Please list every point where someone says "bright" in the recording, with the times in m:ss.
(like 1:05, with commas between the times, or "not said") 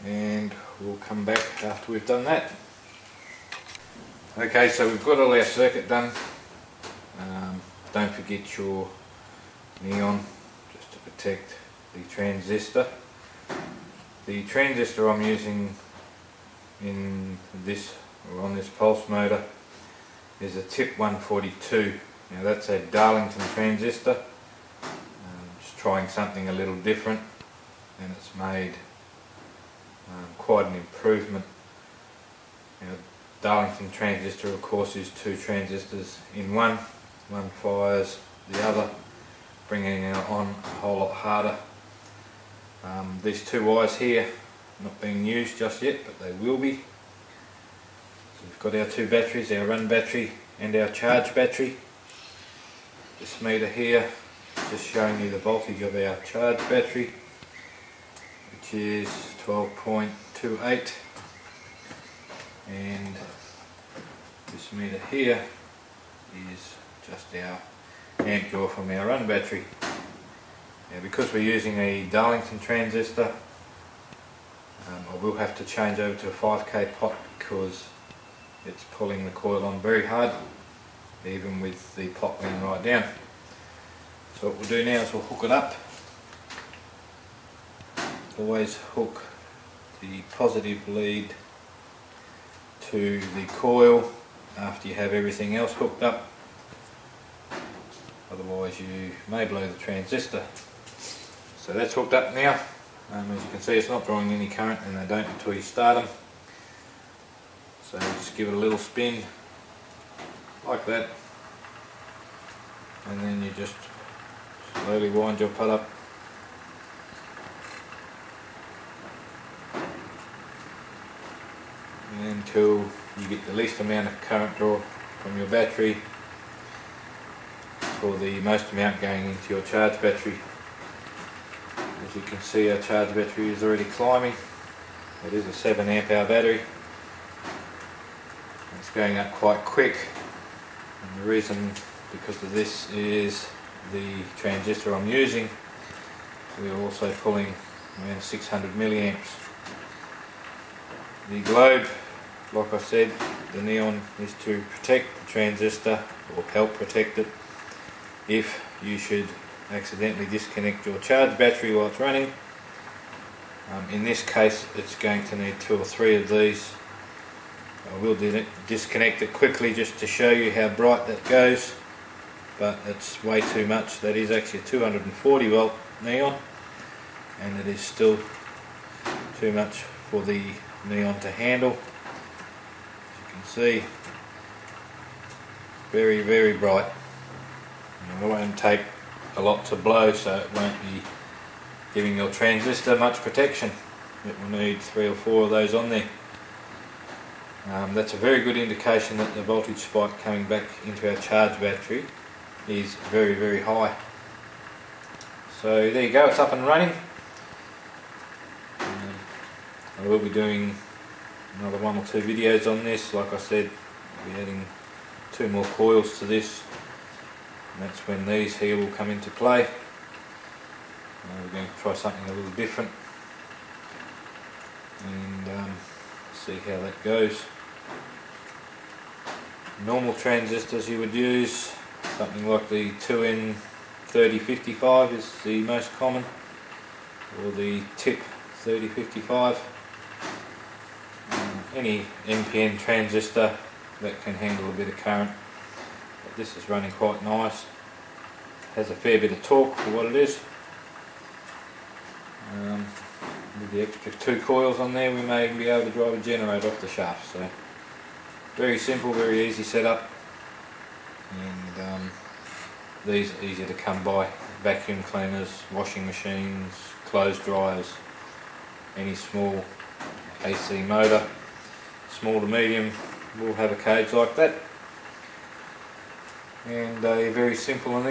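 2:50, 3:06.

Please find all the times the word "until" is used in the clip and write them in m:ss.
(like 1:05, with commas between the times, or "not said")
1:45, 2:02.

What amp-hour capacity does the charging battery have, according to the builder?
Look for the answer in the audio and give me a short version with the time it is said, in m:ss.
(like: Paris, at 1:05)
7 amp hour, at 2:15.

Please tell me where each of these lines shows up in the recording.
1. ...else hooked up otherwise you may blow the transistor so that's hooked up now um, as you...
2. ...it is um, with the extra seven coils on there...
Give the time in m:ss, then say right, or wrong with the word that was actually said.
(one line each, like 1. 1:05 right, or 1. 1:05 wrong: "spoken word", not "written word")
1. 1:35 right
2. 4:10 wrong: "two", not "seven".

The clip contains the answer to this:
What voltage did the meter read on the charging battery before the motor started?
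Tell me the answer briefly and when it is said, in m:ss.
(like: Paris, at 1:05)
12.28, at 0:59.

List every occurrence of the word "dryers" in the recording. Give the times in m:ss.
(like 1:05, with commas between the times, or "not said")
4:27.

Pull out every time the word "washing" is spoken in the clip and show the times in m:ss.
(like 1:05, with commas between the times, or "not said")
4:25.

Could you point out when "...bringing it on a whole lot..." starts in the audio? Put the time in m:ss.
0:39.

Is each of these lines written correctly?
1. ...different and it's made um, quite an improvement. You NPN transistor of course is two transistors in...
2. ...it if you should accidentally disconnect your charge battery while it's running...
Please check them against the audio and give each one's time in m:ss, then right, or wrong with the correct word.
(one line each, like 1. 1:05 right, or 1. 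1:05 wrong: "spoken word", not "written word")
1. 0:26 wrong: "Darlington", not "NPN"
2. 2:37 right.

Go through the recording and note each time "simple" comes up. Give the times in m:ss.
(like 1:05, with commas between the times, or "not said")
4:18, 4:37.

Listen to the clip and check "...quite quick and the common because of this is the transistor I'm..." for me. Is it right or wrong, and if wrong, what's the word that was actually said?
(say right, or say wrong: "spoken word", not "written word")
wrong: "reason", not "common".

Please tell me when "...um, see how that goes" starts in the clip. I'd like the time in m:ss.
3:45.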